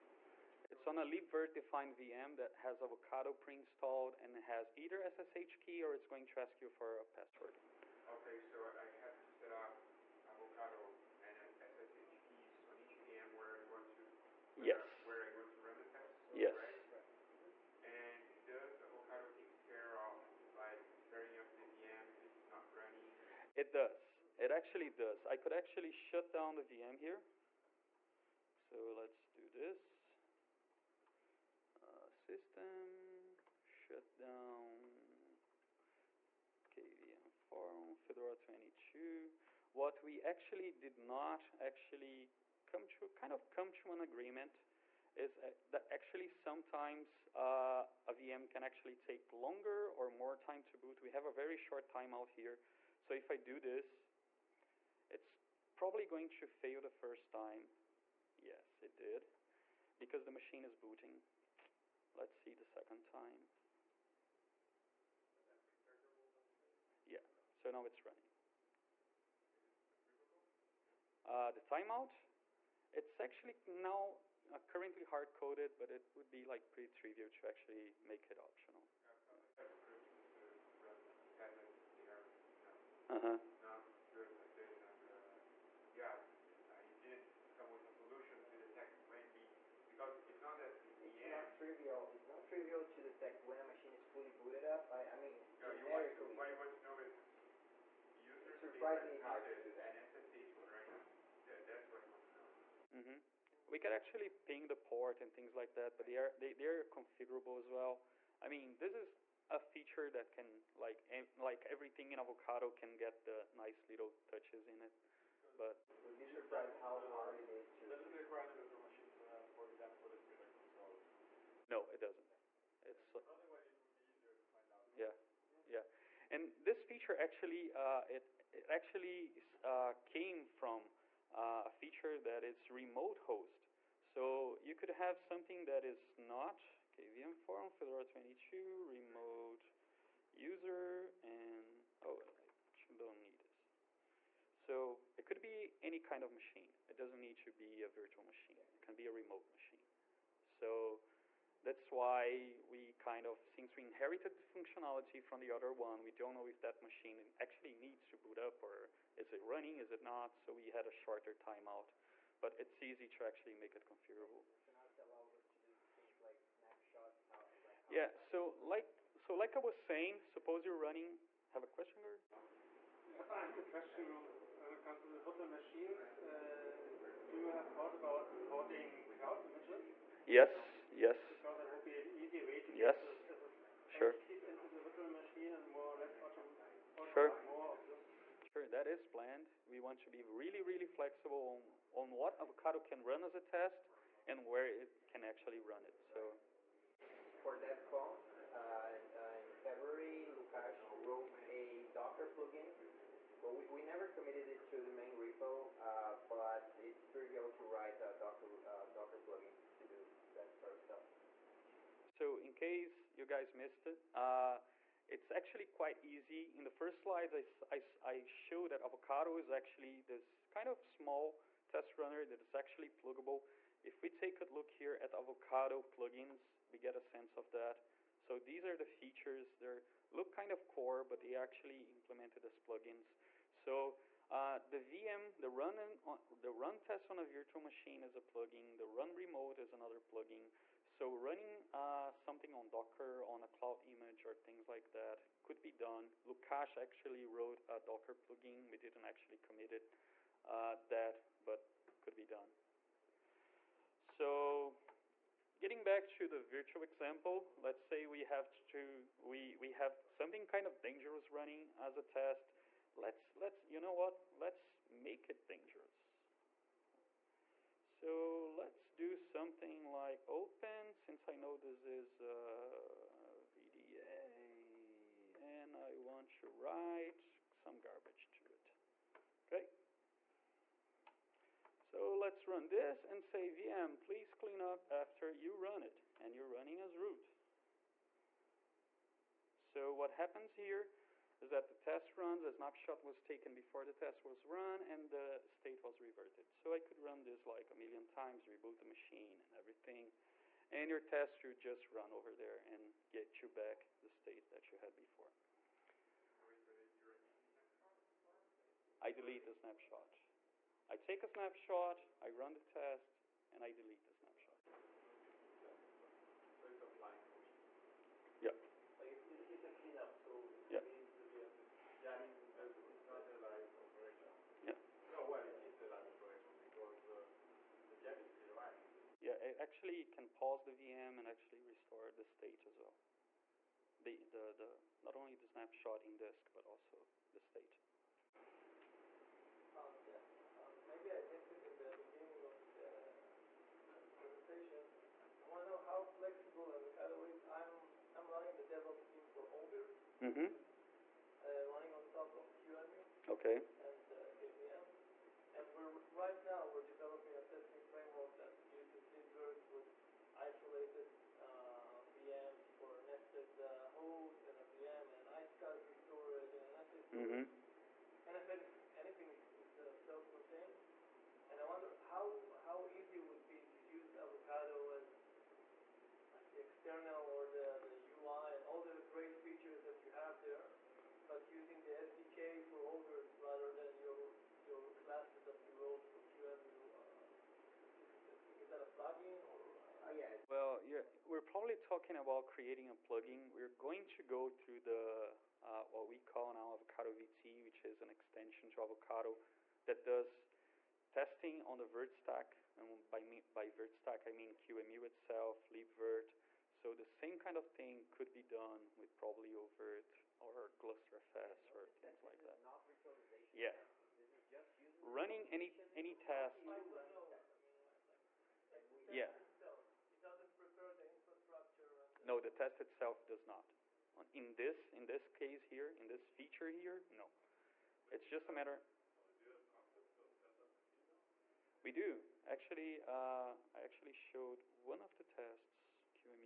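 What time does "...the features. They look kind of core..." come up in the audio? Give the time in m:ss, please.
3:48.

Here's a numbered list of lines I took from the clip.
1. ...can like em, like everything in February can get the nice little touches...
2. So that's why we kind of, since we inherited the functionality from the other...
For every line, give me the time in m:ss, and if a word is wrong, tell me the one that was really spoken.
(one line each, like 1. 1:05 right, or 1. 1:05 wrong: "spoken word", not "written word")
1. 1:50 wrong: "Avocado", not "February"
2. 2:30 right.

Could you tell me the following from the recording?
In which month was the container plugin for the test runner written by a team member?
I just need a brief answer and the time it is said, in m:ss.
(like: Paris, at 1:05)
February, at 3:19.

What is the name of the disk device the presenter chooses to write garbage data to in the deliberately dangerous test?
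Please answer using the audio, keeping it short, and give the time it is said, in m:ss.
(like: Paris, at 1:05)
VDA, at 4:33.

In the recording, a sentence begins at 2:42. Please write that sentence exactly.
But it's easy to actually make it configurable.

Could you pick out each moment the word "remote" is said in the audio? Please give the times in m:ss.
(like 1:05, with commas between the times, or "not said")
2:12, 2:18, 2:29, 3:59.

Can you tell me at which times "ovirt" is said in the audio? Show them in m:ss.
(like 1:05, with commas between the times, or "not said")
5:49, 6:22, 6:49.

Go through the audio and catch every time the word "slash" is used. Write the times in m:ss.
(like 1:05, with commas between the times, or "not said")
not said.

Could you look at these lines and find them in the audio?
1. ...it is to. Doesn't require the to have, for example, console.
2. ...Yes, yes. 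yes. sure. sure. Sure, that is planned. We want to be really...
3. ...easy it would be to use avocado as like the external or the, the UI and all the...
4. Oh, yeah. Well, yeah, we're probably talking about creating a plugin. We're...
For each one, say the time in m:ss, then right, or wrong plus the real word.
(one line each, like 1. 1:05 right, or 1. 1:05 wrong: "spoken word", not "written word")
1. 1:57 right
2. 3:00 right
3. 6:12 right
4. 6:30 right.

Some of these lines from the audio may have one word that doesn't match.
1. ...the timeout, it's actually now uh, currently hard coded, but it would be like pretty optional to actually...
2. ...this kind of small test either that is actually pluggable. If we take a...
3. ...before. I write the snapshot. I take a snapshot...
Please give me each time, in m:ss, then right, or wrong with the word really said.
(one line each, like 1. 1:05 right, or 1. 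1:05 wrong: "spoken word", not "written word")
1. 1:11 wrong: "trivial", not "optional"
2. 3:40 wrong: "runner", not "either"
3. 5:04 wrong: "delete", not "write".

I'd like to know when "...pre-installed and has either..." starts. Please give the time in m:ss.
0:03.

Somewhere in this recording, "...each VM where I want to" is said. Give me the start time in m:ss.
0:12.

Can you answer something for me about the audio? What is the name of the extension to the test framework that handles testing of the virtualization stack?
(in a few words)
Avocado VT.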